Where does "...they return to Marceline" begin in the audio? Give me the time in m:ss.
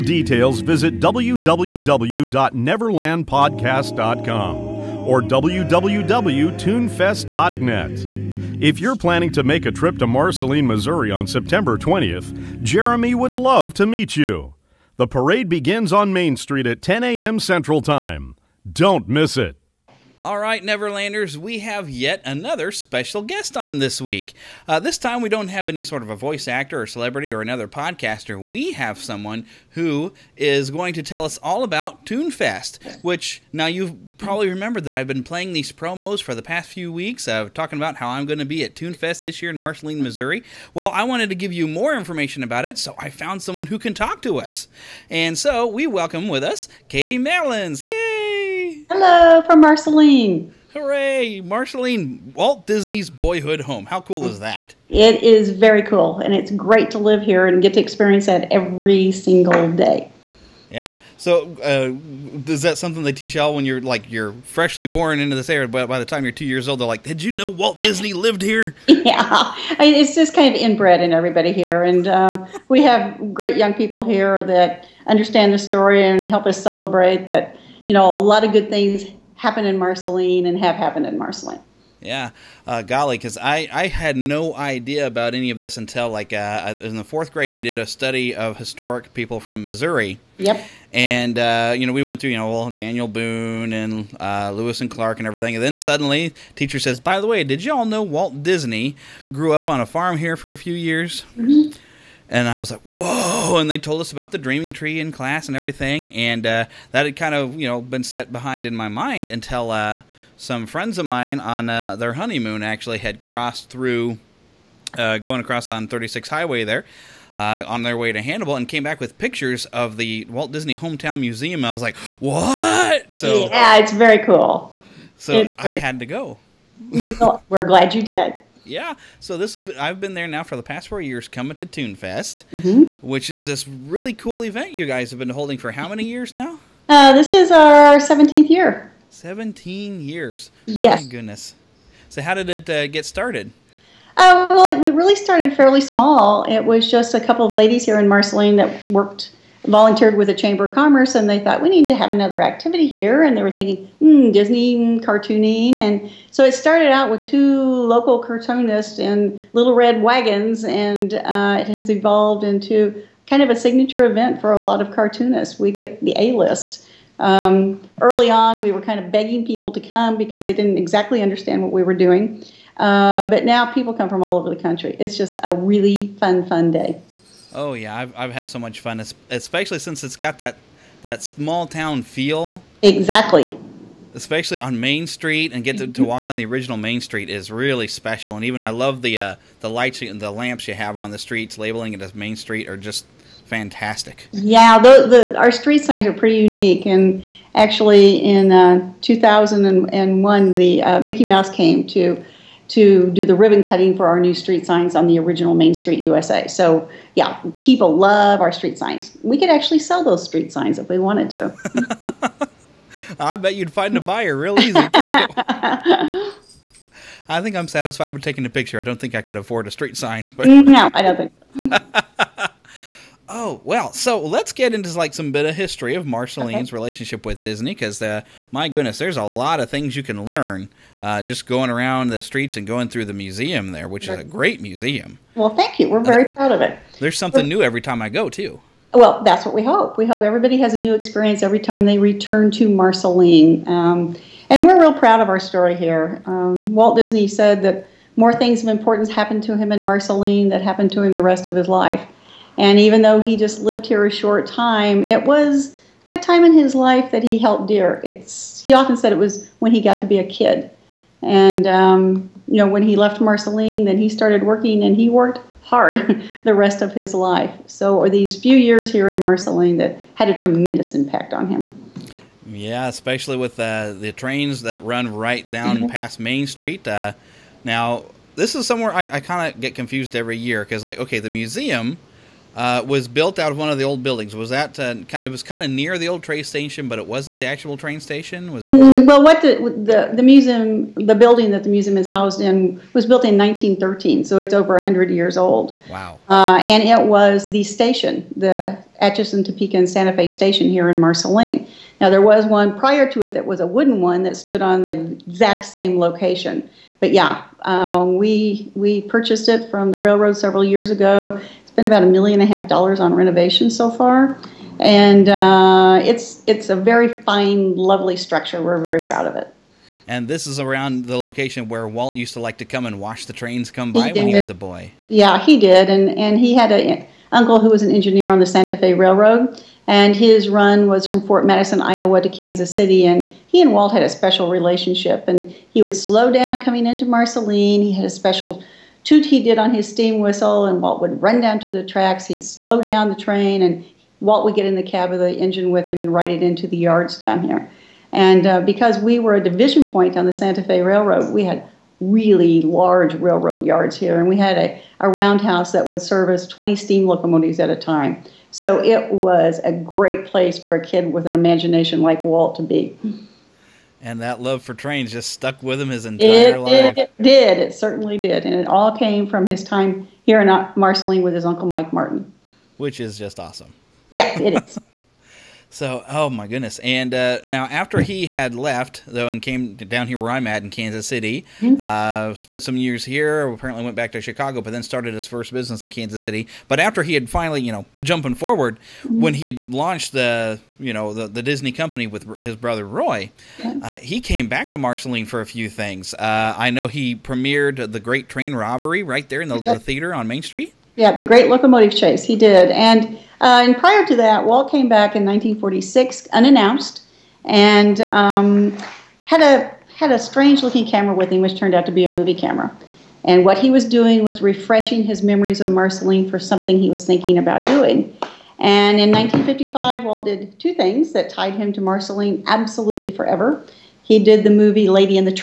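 4:01.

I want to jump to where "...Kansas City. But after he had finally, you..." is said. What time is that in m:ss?
6:25.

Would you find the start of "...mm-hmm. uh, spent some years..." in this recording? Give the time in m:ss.
6:21.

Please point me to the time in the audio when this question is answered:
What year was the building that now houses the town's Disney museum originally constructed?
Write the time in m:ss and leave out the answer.
4:53.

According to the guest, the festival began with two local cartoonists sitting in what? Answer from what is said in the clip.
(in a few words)
little red wagons.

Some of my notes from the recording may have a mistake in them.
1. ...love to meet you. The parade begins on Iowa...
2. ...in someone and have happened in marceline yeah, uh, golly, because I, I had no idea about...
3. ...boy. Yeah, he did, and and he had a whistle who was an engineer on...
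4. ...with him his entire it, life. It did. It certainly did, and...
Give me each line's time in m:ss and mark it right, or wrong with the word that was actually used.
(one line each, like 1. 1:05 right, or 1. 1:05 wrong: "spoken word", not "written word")
1. 0:13 wrong: "Main", not "Iowa"
2. 1:19 wrong: "marceline", not "someone"
3. 5:24 wrong: "uncle", not "whistle"
4. 6:05 right.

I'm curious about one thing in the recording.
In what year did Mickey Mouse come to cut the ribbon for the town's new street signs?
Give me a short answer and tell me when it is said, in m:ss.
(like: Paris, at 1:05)
2001, at 3:19.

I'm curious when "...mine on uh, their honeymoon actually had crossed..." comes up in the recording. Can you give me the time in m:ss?
1:51.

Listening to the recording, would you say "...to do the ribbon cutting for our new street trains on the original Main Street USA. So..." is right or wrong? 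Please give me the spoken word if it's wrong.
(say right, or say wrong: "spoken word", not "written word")
wrong: "signs", not "trains".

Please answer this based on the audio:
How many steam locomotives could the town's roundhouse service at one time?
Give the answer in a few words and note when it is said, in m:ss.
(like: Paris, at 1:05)
20, at 5:56.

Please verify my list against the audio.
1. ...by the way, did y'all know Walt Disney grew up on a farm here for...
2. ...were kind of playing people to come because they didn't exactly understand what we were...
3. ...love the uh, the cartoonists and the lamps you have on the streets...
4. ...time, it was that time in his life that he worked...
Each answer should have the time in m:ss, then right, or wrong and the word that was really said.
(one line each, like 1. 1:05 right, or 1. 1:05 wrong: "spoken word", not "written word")
1. 1:36 right
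2. 2:48 wrong: "begging", not "playing"
3. 3:08 wrong: "lights", not "cartoonists"
4. 4:14 wrong: "helped", not "worked".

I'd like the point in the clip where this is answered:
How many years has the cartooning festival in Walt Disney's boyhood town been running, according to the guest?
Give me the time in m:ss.
2:17.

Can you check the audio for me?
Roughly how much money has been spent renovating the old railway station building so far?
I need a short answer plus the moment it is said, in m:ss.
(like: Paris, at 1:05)
$1.5 million, at 5:12.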